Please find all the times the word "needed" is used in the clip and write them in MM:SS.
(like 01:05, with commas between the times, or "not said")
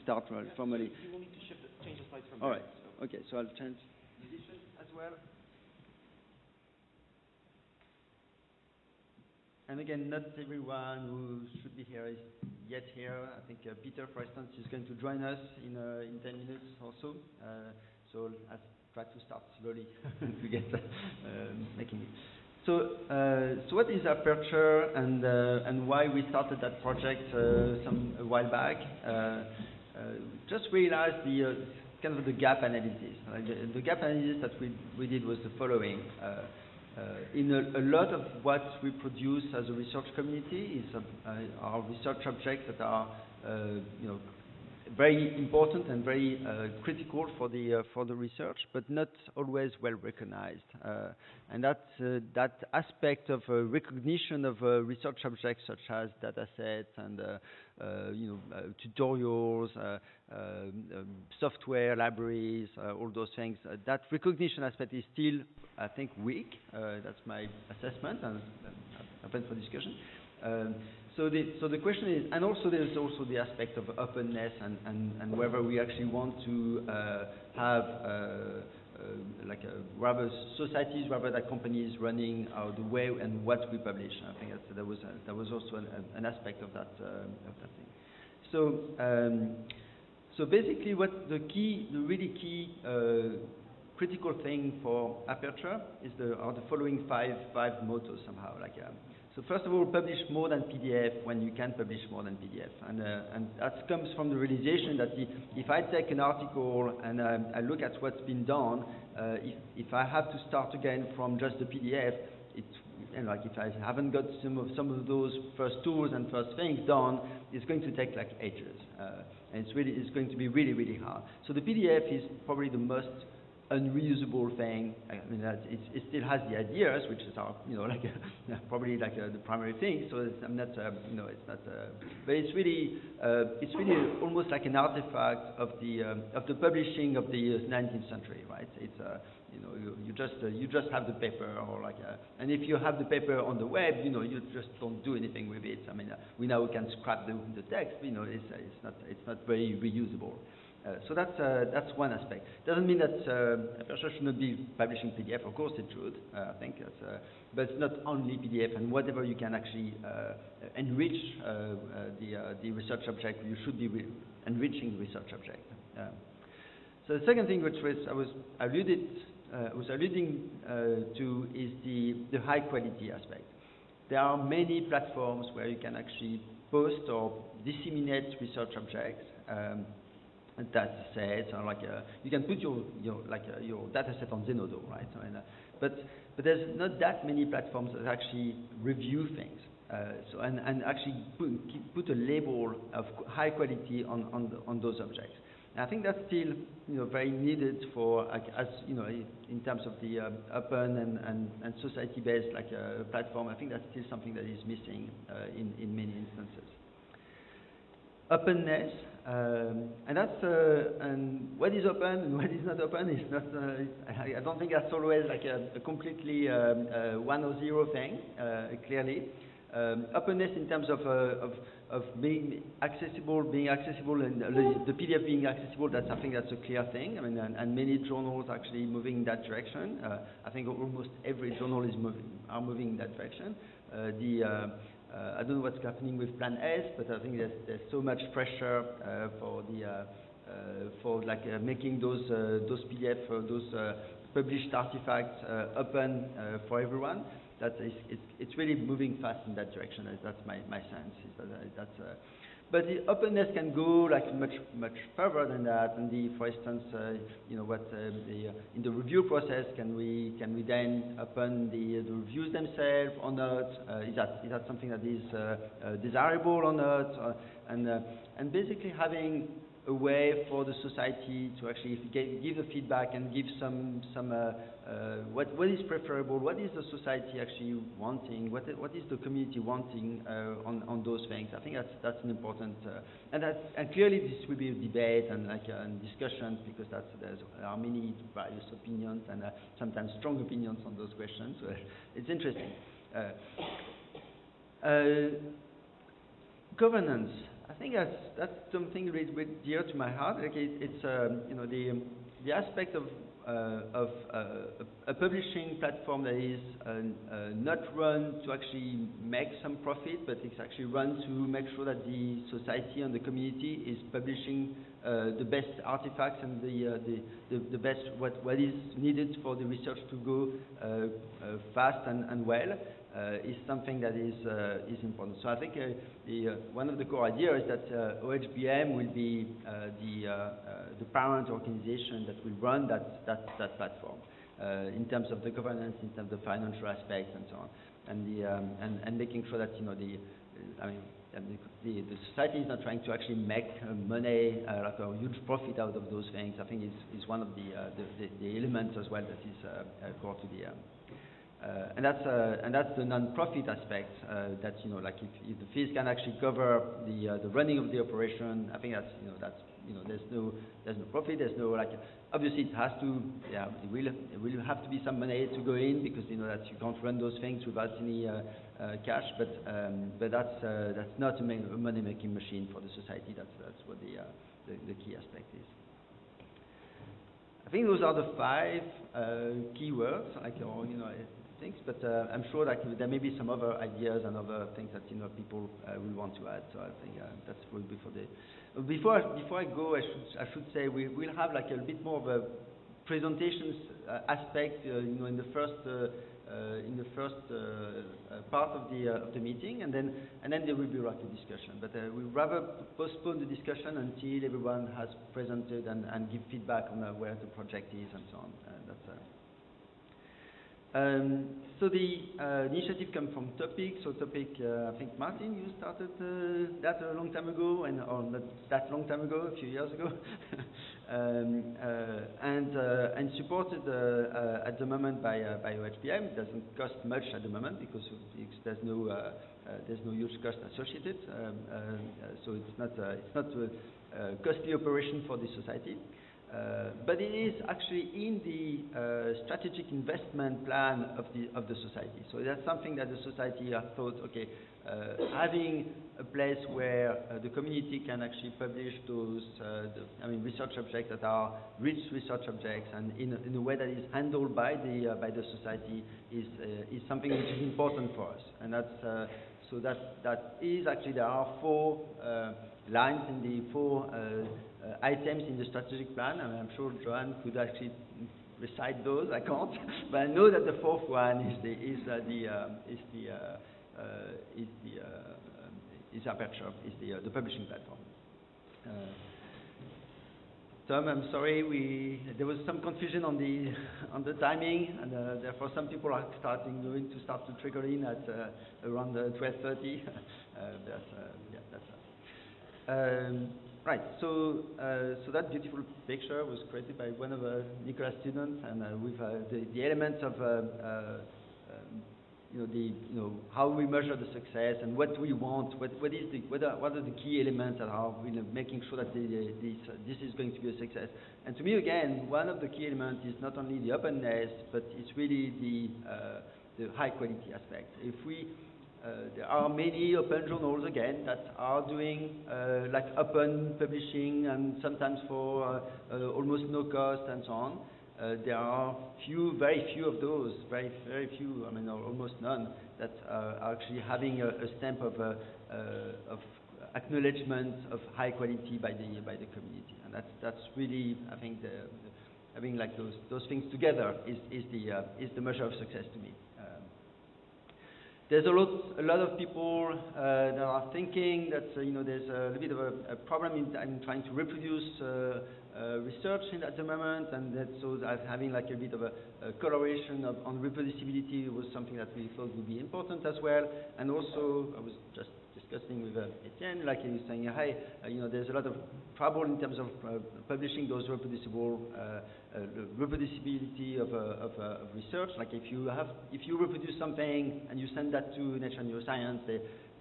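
03:17, 05:18.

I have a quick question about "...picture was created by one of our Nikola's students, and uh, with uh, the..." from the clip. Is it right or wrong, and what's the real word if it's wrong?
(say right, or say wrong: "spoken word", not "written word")
right.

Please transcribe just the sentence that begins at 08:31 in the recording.
And to me, again, one of the key elements is not only the openness, but it's really the the high quality aspect.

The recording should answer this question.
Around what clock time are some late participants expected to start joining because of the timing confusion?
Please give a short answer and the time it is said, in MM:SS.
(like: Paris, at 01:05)
12:30, at 08:09.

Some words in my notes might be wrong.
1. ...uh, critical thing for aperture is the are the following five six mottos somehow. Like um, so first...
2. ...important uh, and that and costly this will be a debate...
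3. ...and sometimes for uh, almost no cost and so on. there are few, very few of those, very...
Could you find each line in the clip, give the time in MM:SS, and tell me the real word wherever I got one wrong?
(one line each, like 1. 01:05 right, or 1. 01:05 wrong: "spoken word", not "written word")
1. 01:32 wrong: "five", not "six"
2. 04:42 wrong: "clearly", not "costly"
3. 08:44 right.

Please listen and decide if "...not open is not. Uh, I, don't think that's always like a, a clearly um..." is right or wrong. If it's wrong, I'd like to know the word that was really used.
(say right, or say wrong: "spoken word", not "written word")
wrong: "completely", not "clearly".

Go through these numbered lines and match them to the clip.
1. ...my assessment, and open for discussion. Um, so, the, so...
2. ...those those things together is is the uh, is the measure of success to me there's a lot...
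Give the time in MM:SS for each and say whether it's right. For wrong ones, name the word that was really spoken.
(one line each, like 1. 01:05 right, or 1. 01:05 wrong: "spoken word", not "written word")
1. 01:07 right
2. 09:02 right.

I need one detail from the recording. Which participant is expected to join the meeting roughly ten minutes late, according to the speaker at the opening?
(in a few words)
Peter.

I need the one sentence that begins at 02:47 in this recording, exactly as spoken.
so the second thing which was, I was alluded, was alluding to is the, the high quality aspect.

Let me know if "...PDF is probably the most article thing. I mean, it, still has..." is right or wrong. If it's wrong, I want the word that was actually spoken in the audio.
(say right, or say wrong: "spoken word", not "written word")
wrong: "unreusable", not "article".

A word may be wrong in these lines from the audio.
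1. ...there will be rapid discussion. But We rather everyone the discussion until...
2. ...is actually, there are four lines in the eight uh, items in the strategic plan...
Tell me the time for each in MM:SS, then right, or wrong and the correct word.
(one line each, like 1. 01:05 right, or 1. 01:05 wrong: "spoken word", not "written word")
1. 06:40 wrong: "postpone", not "everyone"
2. 07:40 wrong: "four", not "eight".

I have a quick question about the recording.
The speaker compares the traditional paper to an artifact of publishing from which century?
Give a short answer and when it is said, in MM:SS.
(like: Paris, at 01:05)
19th century, at 02:17.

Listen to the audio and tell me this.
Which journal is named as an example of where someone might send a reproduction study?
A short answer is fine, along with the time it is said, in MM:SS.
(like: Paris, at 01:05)
Nature Neuroscience, at 09:38.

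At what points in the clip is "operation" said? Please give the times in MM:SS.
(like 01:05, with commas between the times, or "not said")
05:57, 07:14.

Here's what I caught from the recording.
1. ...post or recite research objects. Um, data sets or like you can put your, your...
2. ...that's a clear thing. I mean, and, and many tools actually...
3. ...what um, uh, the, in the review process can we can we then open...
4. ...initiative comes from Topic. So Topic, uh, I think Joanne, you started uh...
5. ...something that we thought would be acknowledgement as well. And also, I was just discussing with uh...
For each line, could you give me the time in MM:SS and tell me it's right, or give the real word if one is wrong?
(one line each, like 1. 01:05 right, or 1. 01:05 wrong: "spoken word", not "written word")
1. 02:56 wrong: "disseminate", not "recite"
2. 03:46 wrong: "journals", not "tools"
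3. 04:17 right
4. 06:52 wrong: "Martin", not "Joanne"
5. 09:21 wrong: "important", not "acknowledgement".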